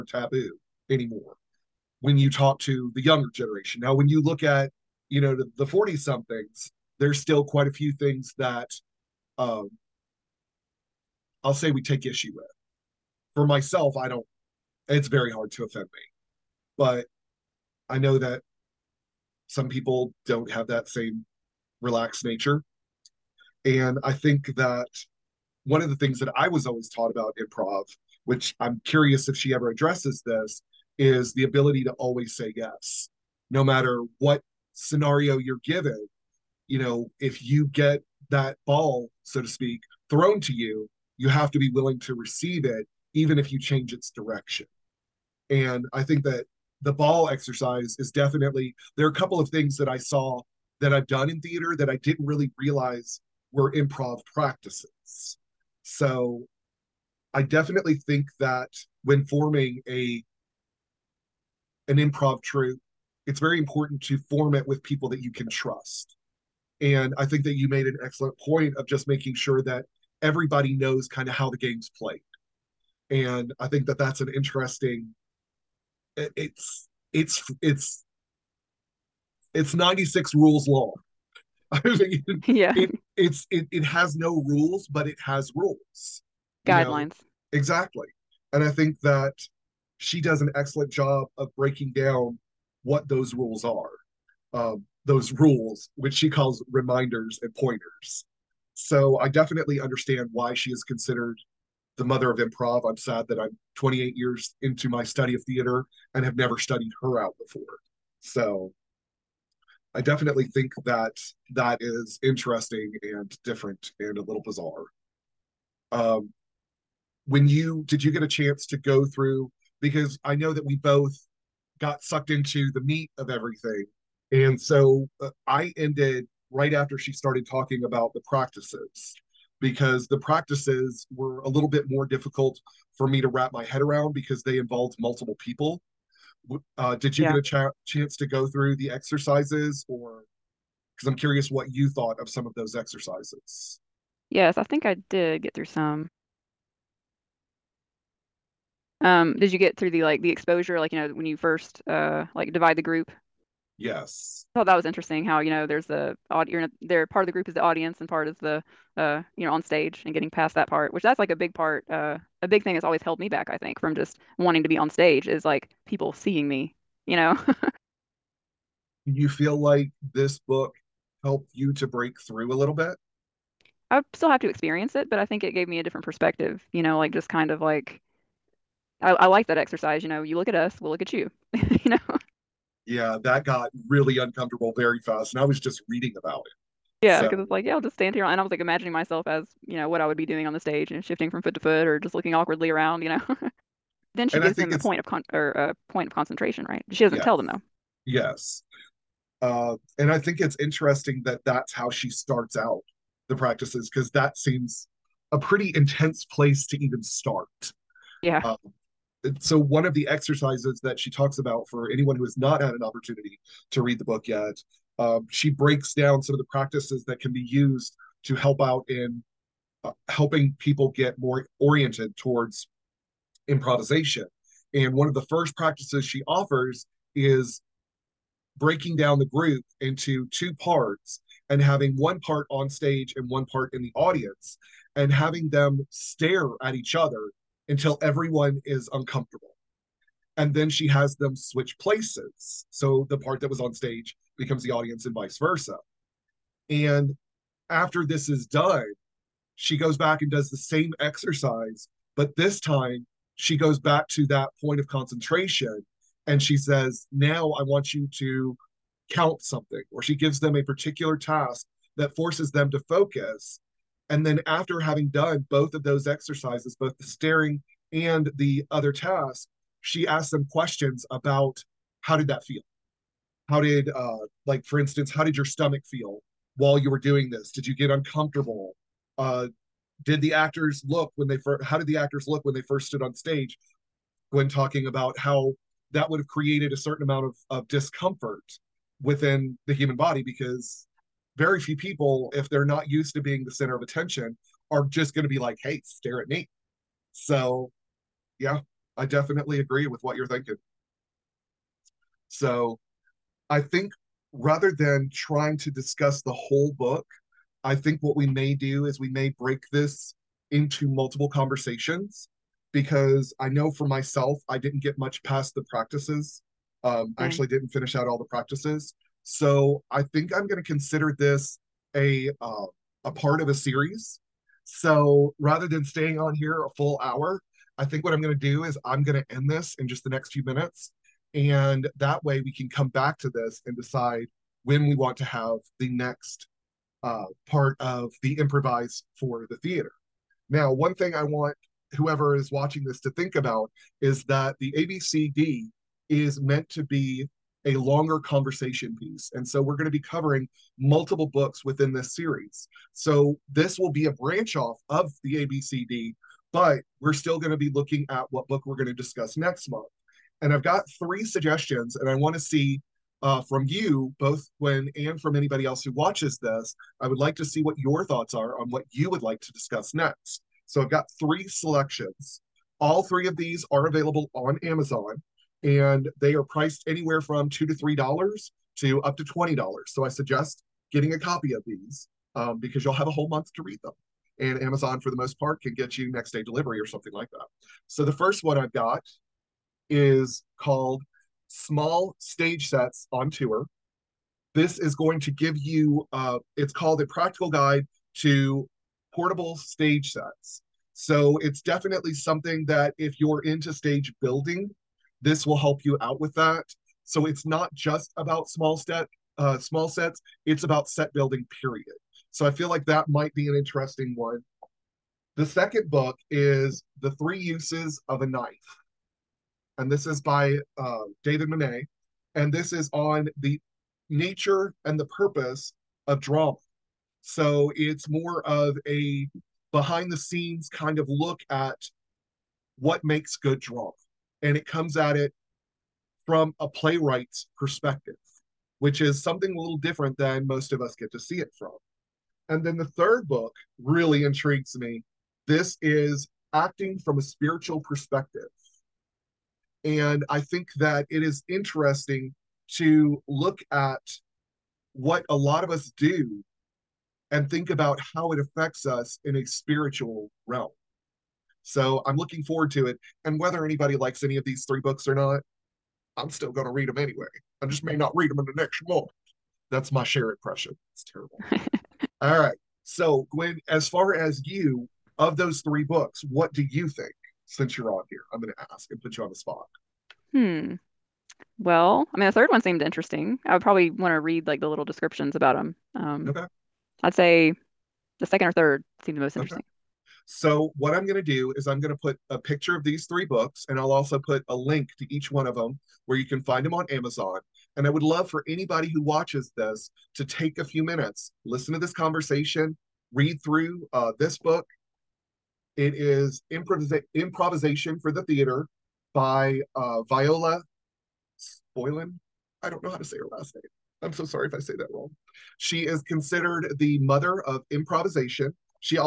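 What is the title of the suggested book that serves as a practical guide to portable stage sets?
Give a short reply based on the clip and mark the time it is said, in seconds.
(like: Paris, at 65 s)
Small Stage Sets on Tour, at 391 s.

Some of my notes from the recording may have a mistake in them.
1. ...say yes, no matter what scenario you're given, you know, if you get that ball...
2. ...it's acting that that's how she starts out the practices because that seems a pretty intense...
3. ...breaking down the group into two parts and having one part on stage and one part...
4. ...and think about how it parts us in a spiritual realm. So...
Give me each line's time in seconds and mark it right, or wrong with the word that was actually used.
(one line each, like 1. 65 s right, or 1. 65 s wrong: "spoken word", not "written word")
1. 32 s right
2. 200 s wrong: "interesting", not "acting"
3. 228 s right
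4. 457 s wrong: "affects", not "parts".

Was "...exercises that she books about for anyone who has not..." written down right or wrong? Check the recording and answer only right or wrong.
wrong.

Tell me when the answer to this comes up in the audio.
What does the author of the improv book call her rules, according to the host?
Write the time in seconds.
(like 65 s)
96 s.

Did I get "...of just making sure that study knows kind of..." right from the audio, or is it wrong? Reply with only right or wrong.
wrong.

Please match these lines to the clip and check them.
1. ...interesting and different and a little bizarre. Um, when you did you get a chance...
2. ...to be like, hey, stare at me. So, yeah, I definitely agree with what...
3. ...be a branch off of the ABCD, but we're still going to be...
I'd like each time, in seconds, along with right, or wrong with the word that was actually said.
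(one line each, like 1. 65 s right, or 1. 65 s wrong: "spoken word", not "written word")
1. 112 s right
2. 295 s right
3. 353 s right.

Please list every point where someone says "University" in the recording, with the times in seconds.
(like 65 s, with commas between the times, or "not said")
not said.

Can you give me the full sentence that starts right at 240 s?
And then she has them switch places.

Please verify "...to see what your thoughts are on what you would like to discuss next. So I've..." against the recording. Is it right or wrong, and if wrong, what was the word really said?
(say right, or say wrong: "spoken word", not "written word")
right.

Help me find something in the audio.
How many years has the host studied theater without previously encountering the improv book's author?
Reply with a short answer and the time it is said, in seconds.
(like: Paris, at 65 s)
28, at 103 s.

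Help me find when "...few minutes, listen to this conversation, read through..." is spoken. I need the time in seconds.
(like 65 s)
500 s.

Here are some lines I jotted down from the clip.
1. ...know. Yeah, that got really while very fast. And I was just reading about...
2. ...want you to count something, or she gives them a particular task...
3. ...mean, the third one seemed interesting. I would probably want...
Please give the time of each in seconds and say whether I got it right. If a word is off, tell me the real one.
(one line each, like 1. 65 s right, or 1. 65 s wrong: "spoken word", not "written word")
1. 181 s wrong: "uncomfortable", not "while"
2. 257 s right
3. 482 s right.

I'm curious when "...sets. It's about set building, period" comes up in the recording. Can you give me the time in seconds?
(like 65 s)
409 s.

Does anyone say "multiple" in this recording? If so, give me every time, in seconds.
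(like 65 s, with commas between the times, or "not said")
134 s, 310 s, 350 s.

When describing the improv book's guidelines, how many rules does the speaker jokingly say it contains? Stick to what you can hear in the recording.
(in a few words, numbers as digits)
96.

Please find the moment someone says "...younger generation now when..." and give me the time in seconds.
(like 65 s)
3 s.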